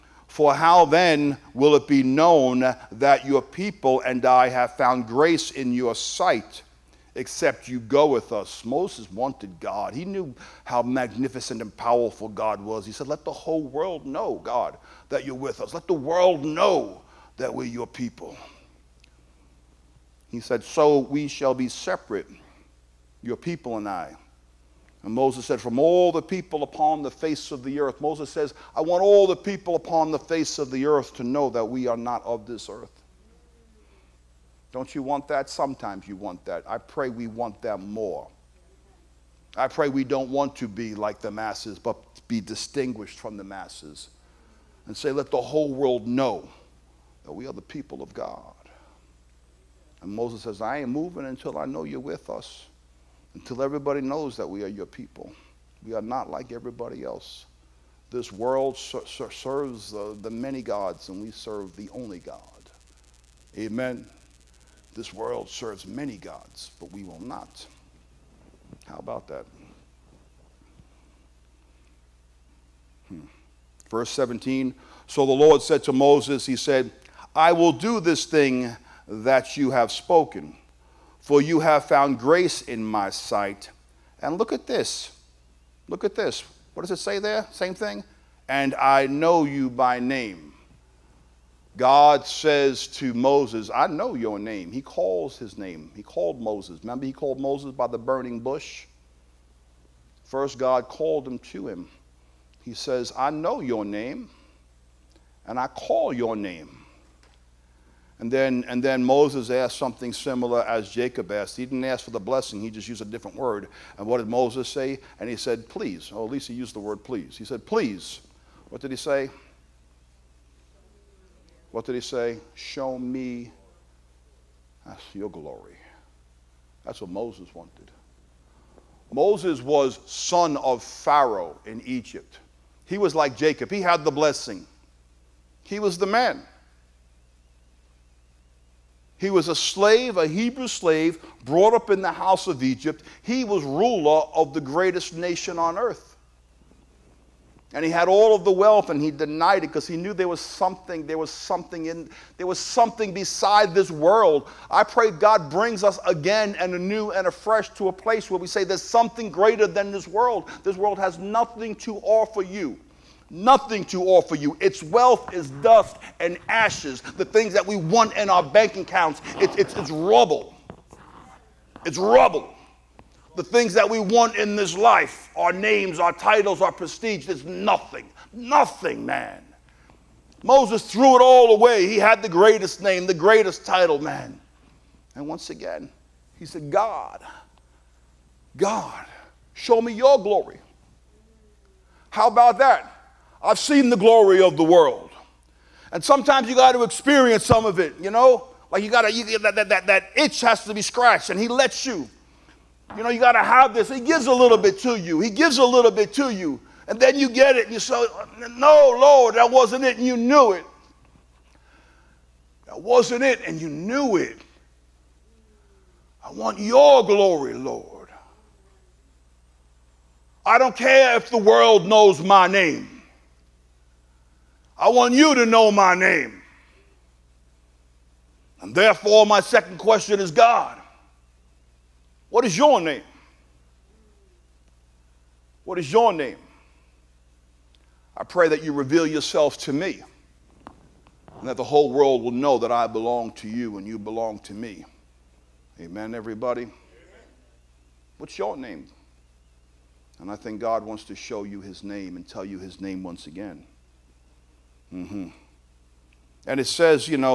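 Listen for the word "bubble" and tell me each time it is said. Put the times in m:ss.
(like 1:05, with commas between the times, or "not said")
not said.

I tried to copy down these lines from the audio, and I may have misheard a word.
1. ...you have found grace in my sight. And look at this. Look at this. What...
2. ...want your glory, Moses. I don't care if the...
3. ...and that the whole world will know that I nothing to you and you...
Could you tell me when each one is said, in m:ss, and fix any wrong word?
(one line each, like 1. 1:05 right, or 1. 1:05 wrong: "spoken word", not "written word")
1. 1:21 right
2. 3:36 wrong: "Lord", not "Moses"
3. 4:01 wrong: "belong", not "nothing".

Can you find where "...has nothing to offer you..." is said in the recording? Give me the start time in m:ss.
2:40.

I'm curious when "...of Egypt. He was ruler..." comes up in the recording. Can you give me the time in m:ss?
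2:22.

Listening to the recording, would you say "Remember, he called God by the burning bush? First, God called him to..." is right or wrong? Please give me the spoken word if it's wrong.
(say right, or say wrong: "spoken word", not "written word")
wrong: "Moses", not "God".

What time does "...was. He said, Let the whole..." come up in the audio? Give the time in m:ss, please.
0:12.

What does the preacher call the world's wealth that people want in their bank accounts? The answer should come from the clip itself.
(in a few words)
Dust and ashes.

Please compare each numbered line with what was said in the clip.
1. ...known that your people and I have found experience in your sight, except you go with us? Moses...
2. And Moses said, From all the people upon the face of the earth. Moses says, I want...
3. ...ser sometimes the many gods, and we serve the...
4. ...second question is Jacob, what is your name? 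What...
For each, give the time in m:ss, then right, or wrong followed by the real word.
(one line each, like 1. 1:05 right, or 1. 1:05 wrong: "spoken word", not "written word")
1. 0:02 wrong: "grace", not "experience"
2. 0:25 right
3. 0:59 wrong: "serves", not "sometimes"
4. 3:49 wrong: "God", not "Jacob".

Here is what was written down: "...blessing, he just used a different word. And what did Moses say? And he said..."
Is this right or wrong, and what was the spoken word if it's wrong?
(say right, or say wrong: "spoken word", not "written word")
right.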